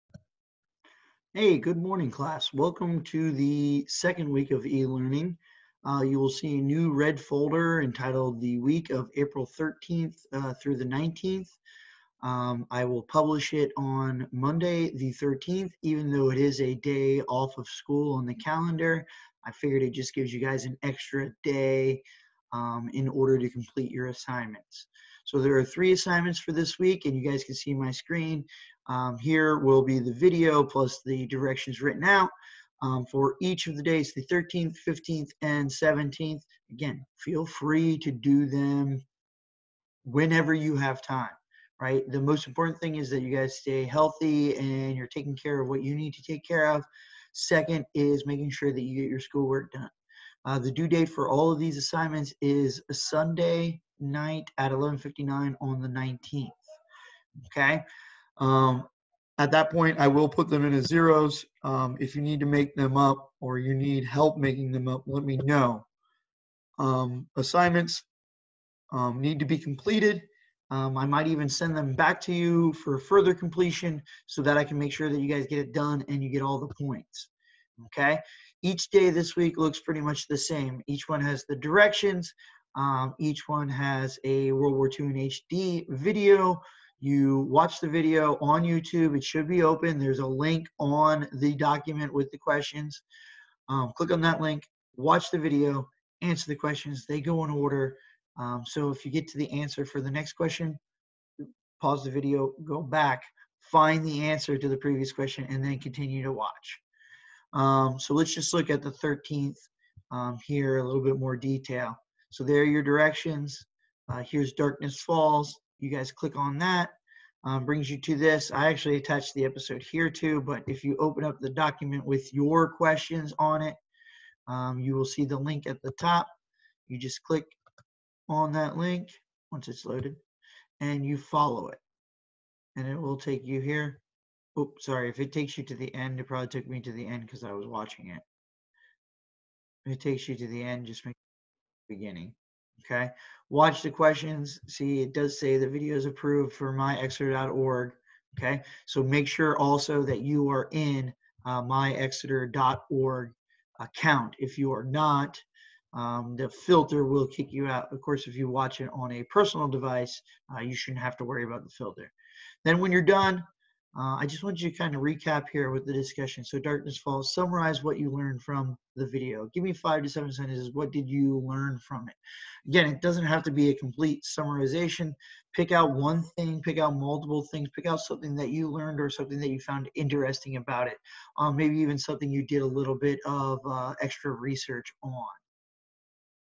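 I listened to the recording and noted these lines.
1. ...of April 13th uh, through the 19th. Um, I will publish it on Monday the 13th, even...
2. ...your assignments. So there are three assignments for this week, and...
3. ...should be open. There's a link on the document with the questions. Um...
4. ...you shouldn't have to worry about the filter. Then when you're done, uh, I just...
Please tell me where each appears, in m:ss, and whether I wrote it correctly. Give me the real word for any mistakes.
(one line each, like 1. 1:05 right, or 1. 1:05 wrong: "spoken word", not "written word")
1. 0:08 right
2. 0:23 right
3. 1:29 right
4. 2:40 right.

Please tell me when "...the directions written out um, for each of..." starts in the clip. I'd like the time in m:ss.
0:31.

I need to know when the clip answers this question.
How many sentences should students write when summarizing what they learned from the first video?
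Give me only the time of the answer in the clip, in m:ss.
2:49.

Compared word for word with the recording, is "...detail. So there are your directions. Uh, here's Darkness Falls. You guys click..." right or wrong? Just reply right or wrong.
right.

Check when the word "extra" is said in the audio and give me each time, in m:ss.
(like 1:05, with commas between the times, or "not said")
0:20, 3:04.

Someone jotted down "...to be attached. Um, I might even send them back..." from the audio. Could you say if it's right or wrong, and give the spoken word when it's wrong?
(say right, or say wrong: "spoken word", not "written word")
wrong: "completed", not "attached".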